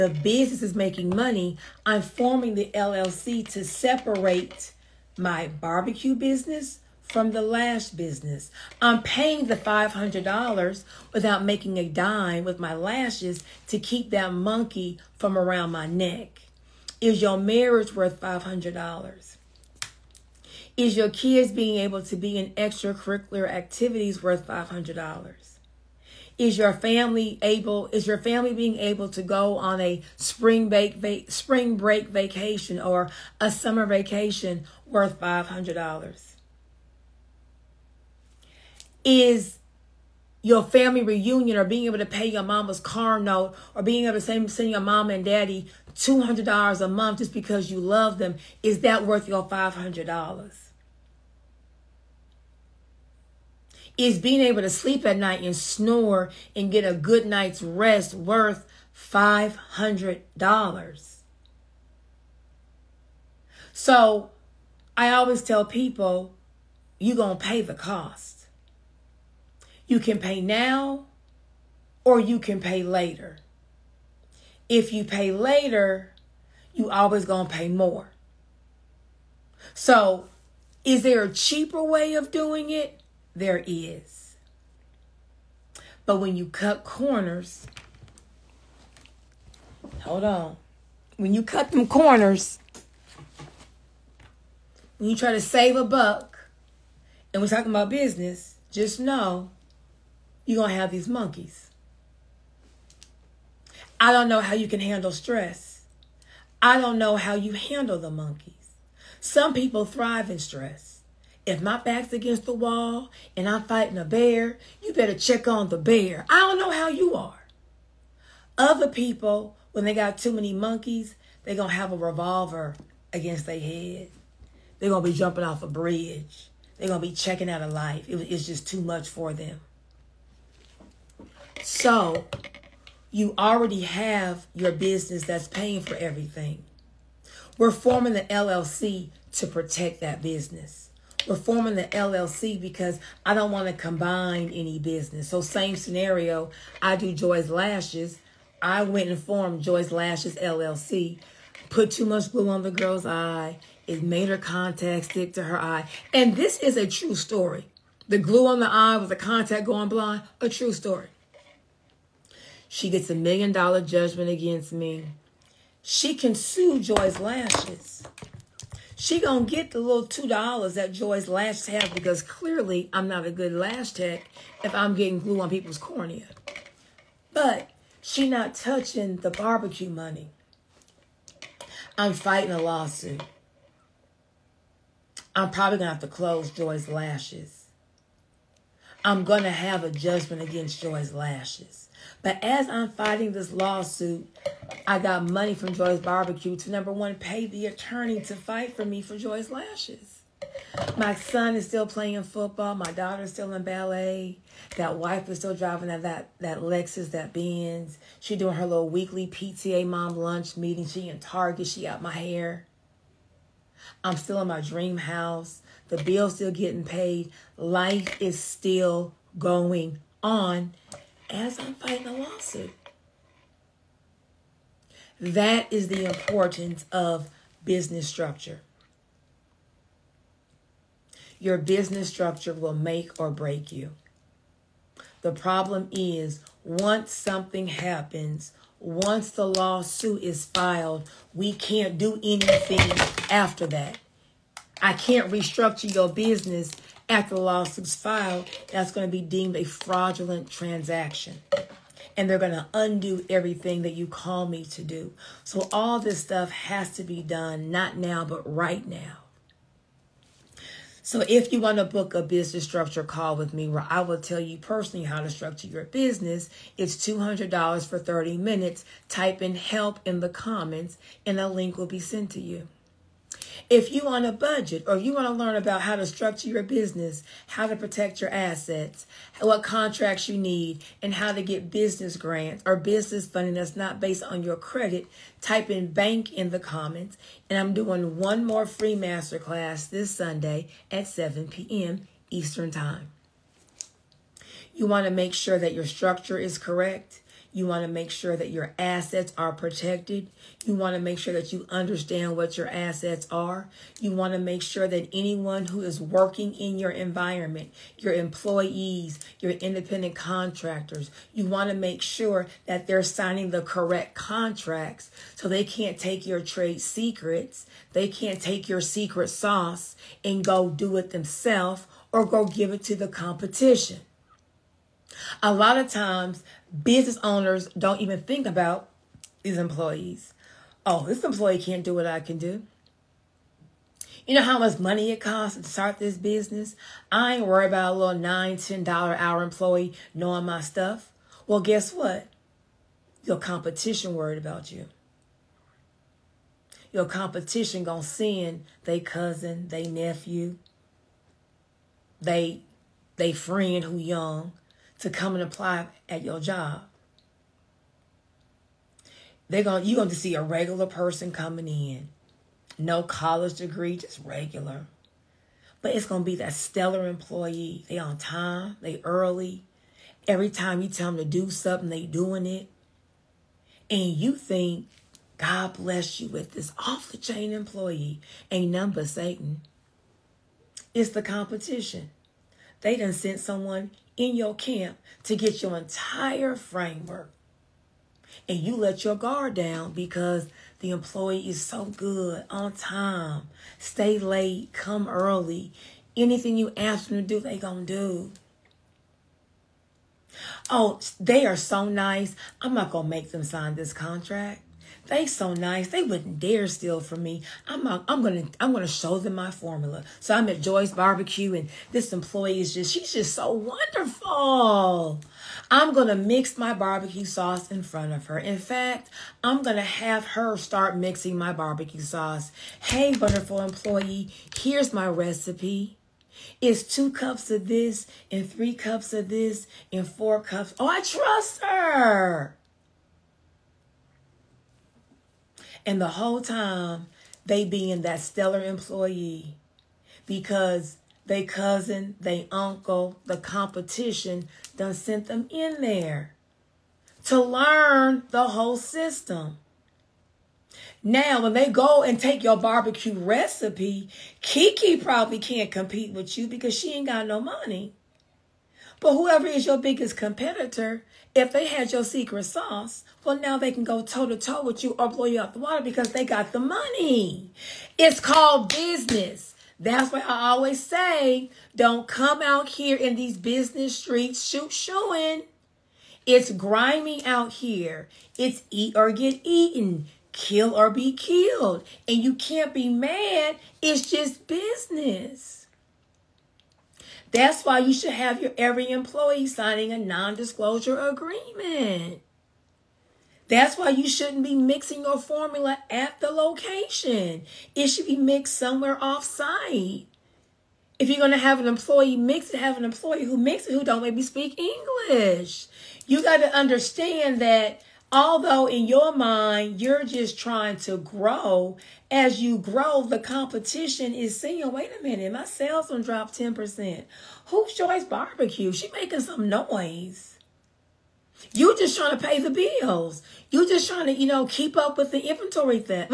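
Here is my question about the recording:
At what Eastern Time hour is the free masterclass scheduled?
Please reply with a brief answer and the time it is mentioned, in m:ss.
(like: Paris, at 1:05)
7 p.m., at 4:51.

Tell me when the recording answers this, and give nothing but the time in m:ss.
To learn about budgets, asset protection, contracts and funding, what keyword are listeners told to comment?
4:45.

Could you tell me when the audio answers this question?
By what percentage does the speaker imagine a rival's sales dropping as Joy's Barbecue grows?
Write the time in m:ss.
8:36.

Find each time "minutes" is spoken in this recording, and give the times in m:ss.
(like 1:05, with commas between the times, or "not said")
4:28, 8:35.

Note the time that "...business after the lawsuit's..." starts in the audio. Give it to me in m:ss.
4:06.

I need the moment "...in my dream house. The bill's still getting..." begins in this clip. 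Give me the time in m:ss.
3:34.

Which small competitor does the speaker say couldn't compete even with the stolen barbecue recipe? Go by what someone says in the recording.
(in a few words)
Kiki.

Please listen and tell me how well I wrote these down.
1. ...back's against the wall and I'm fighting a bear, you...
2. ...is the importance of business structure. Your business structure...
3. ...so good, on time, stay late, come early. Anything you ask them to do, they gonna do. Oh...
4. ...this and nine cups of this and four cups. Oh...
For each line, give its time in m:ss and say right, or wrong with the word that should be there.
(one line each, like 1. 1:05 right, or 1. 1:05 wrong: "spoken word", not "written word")
1. 1:51 right
2. 3:45 right
3. 6:31 right
4. 7:07 wrong: "three", not "nine".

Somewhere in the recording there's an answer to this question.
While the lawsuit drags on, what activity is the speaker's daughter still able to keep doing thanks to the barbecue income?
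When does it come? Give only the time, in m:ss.
3:23.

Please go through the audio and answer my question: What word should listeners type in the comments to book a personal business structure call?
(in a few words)
help.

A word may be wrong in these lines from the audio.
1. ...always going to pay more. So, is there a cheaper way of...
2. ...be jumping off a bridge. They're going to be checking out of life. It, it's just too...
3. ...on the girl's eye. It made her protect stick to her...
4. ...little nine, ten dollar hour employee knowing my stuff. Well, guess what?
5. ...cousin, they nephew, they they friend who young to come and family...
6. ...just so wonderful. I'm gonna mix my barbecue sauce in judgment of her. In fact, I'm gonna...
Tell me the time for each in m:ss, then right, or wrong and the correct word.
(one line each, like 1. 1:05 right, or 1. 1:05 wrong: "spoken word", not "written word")
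1. 1:16 right
2. 2:05 right
3. 2:32 wrong: "contact", not "protect"
4. 5:37 right
5. 5:48 wrong: "apply", not "family"
6. 6:53 wrong: "front", not "judgment".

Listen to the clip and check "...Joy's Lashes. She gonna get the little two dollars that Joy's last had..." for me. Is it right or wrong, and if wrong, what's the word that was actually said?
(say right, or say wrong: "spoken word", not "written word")
right.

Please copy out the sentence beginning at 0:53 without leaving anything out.
is being able to sleep at night and snore and get a good night's rest worth $500.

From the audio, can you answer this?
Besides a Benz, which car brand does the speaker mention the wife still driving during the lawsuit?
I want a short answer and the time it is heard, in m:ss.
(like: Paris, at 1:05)
Lexus, at 3:26.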